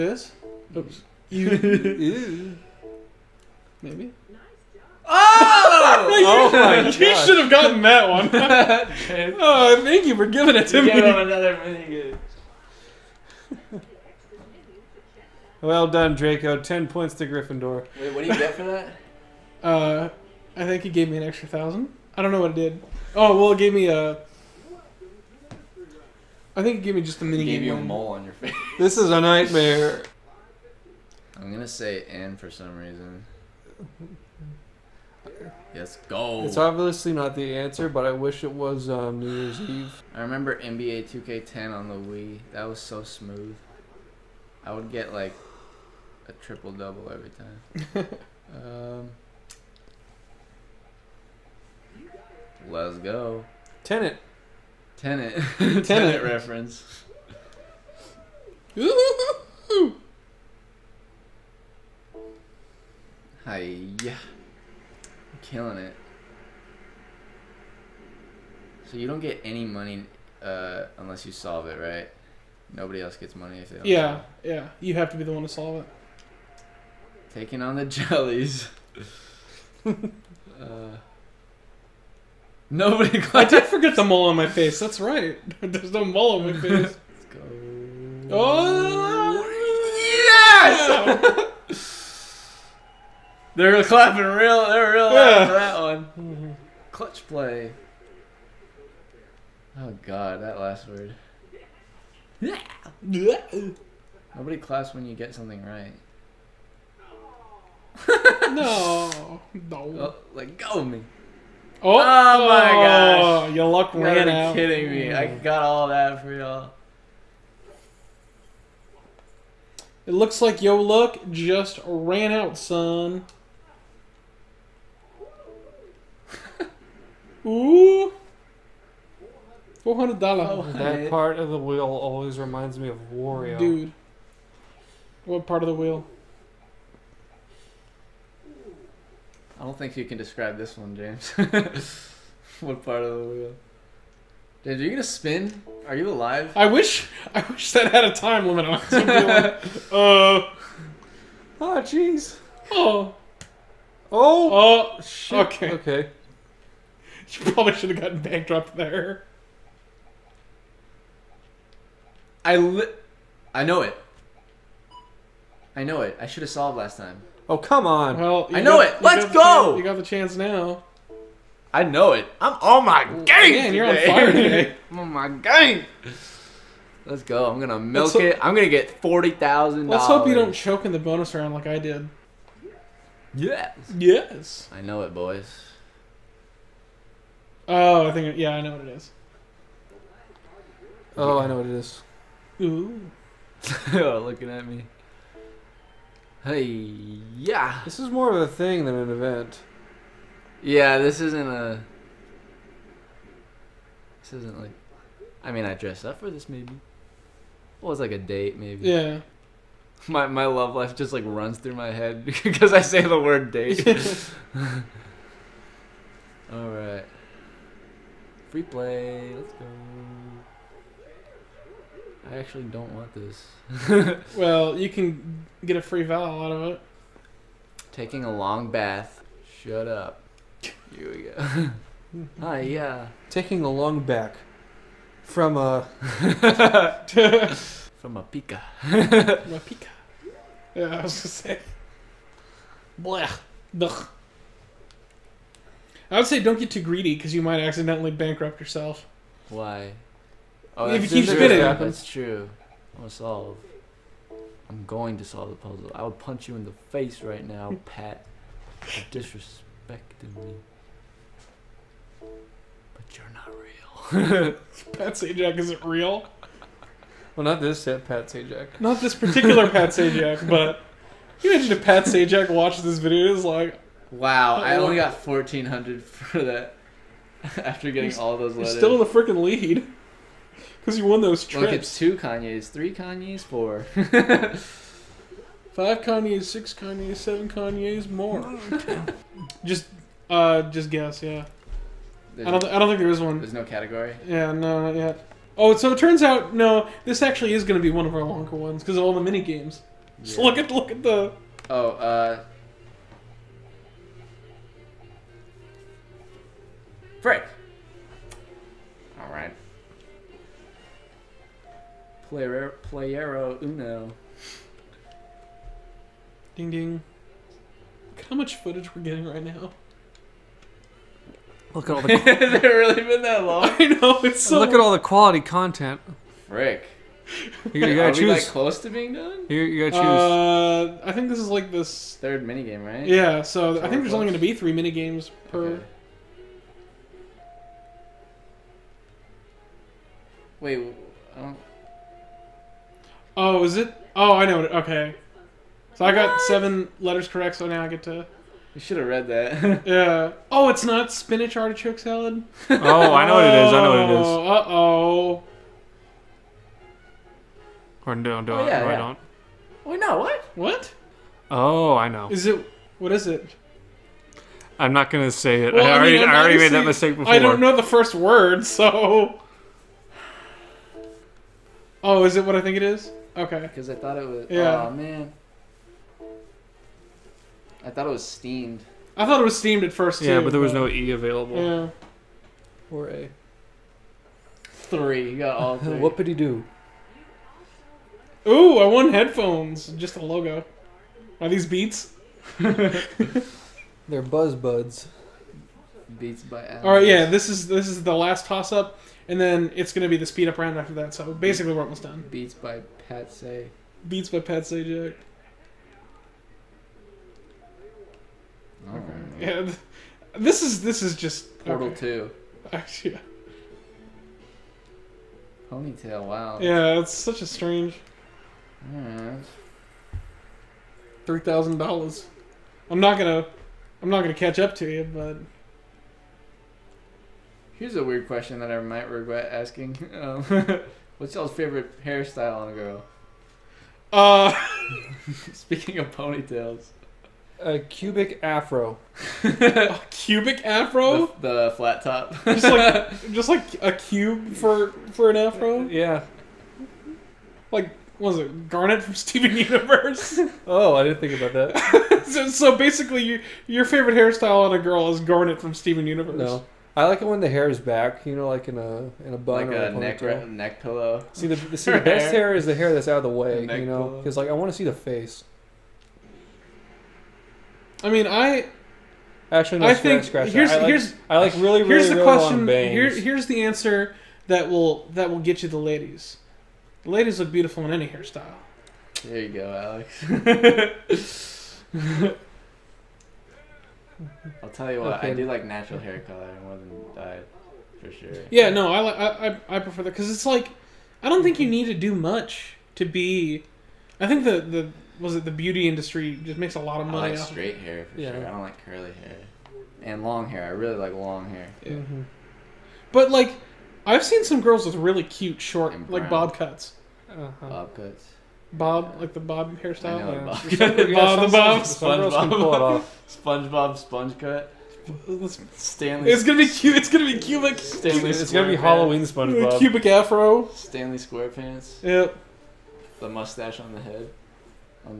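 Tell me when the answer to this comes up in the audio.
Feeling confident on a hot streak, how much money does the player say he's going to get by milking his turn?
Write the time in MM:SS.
02:59.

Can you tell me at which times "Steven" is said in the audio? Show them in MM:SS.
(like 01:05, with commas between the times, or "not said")
07:29, 07:35.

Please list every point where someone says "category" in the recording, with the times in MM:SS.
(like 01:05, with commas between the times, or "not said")
04:53.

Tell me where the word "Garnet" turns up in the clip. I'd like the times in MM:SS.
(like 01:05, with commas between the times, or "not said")
07:28, 07:35.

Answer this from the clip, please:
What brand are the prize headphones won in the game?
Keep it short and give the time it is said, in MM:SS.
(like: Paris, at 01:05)
Buzz Buds, at 06:34.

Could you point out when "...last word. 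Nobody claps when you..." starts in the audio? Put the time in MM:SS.
01:40.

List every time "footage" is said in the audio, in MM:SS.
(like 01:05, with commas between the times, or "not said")
05:18.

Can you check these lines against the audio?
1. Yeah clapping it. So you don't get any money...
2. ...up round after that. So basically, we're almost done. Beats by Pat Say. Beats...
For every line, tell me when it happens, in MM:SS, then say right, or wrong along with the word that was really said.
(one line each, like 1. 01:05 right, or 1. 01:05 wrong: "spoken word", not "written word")
1. 01:04 wrong: "killing", not "clapping"
2. 06:40 right.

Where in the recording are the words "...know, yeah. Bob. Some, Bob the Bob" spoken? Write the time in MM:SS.
08:30.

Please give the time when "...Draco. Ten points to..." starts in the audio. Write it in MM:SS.
00:16.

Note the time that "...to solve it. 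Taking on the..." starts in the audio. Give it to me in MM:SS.
01:15.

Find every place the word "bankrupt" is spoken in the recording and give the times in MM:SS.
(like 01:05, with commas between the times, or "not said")
02:38, 04:08.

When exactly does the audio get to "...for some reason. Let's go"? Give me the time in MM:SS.
00:32.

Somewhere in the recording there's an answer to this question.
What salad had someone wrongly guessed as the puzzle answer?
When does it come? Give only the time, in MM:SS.
05:51.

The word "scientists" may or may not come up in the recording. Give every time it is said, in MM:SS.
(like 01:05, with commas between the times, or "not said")
not said.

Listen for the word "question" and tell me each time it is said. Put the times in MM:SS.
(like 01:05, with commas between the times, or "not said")
07:08, 07:52.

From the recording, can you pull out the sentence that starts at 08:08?
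Yeah, no, I I I, I prefer that because it's like, I don't think you mm-hmm.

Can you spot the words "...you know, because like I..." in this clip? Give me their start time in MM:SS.
07:43.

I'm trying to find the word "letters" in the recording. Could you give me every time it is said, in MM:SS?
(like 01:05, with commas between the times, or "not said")
04:38, 05:46.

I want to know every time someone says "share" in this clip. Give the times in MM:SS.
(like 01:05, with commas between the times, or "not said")
not said.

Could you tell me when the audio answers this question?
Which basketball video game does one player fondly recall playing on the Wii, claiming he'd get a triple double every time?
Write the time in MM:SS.
00:40.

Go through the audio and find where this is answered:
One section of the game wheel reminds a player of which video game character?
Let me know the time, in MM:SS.
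02:13.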